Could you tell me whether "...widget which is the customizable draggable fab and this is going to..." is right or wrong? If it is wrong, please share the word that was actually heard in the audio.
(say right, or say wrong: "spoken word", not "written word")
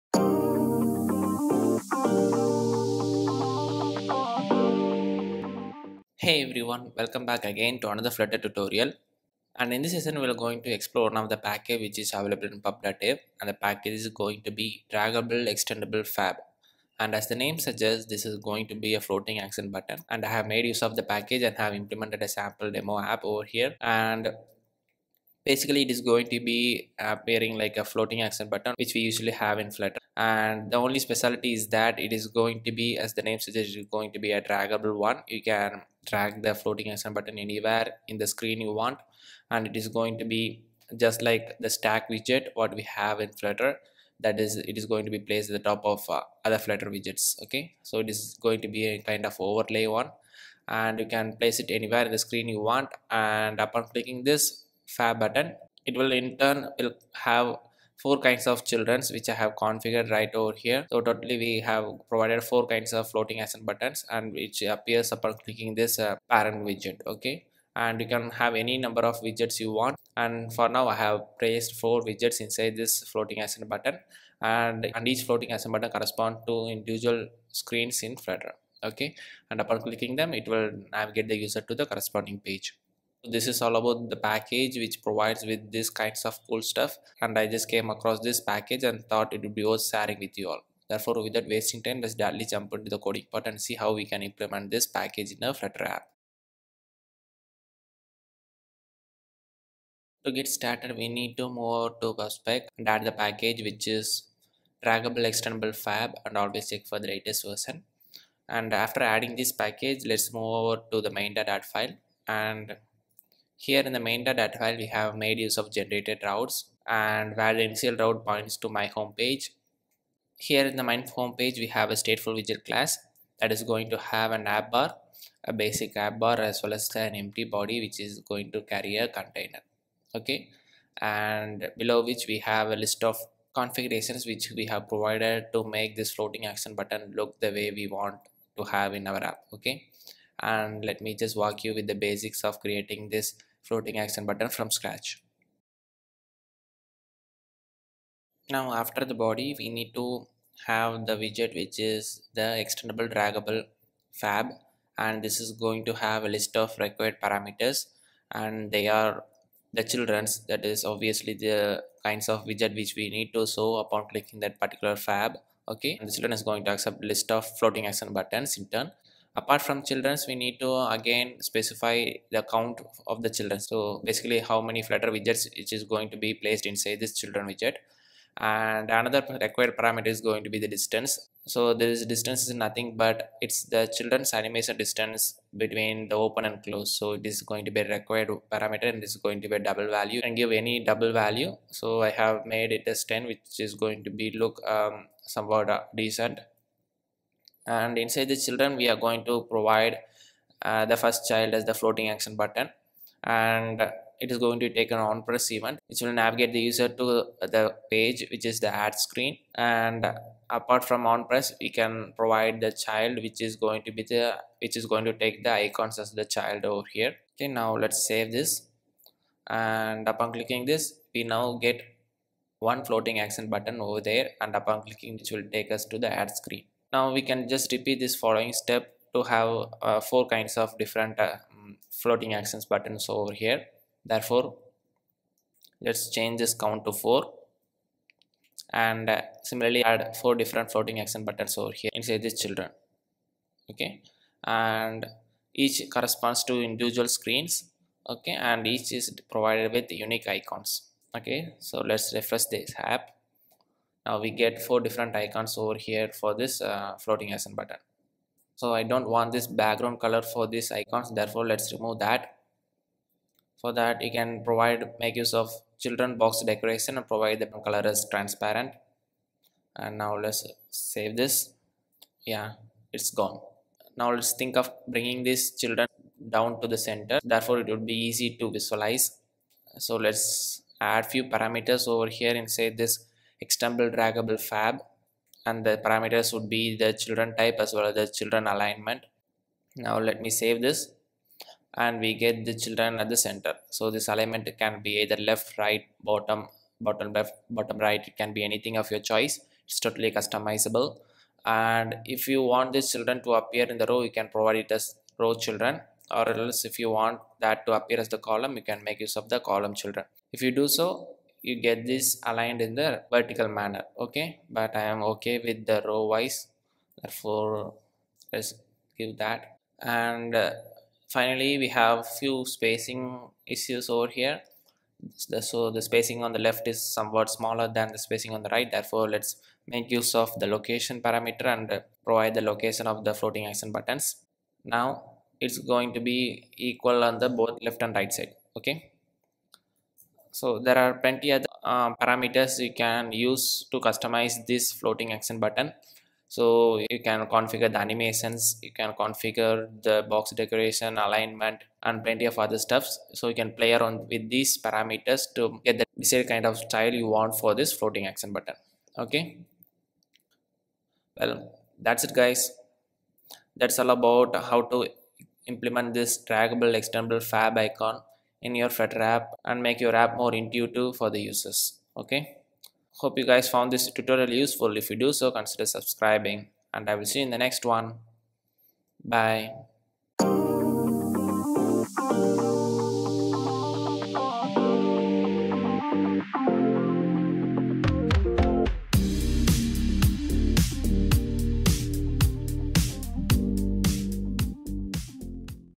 wrong: "expandable", not "customizable".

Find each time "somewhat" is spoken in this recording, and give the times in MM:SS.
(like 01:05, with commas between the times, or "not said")
03:15, 05:26.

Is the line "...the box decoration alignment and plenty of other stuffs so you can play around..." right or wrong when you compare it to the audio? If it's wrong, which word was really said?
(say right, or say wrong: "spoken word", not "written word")
right.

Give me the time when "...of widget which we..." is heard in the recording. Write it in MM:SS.
02:42.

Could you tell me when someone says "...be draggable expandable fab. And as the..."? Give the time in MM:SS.
00:14.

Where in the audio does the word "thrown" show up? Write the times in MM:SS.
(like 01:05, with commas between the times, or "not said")
not said.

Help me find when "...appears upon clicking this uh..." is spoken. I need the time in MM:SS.
01:04.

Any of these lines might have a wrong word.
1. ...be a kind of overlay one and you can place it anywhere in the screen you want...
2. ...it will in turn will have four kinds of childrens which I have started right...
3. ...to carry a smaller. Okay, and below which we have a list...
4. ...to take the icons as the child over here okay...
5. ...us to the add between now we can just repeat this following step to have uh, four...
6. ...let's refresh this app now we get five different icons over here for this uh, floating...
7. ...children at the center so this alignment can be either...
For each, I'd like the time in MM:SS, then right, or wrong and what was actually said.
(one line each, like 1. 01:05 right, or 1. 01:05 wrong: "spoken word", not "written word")
1. 00:48 right
2. 00:55 wrong: "configured", not "started"
3. 02:08 wrong: "container", not "smaller"
4. 03:35 right
5. 03:45 wrong: "screen", not "between"
6. 04:11 wrong: "four", not "five"
7. 04:52 right.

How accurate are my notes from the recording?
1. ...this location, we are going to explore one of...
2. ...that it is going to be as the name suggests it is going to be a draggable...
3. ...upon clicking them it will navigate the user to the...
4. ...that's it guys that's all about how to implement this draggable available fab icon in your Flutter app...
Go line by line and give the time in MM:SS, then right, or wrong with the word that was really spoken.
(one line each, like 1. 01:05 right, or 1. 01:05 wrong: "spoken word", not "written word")
1. 00:09 wrong: "session", not "location"
2. 00:31 right
3. 01:19 right
4. 06:01 wrong: "expandable", not "available".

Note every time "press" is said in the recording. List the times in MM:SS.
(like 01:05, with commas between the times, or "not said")
03:25, 03:31.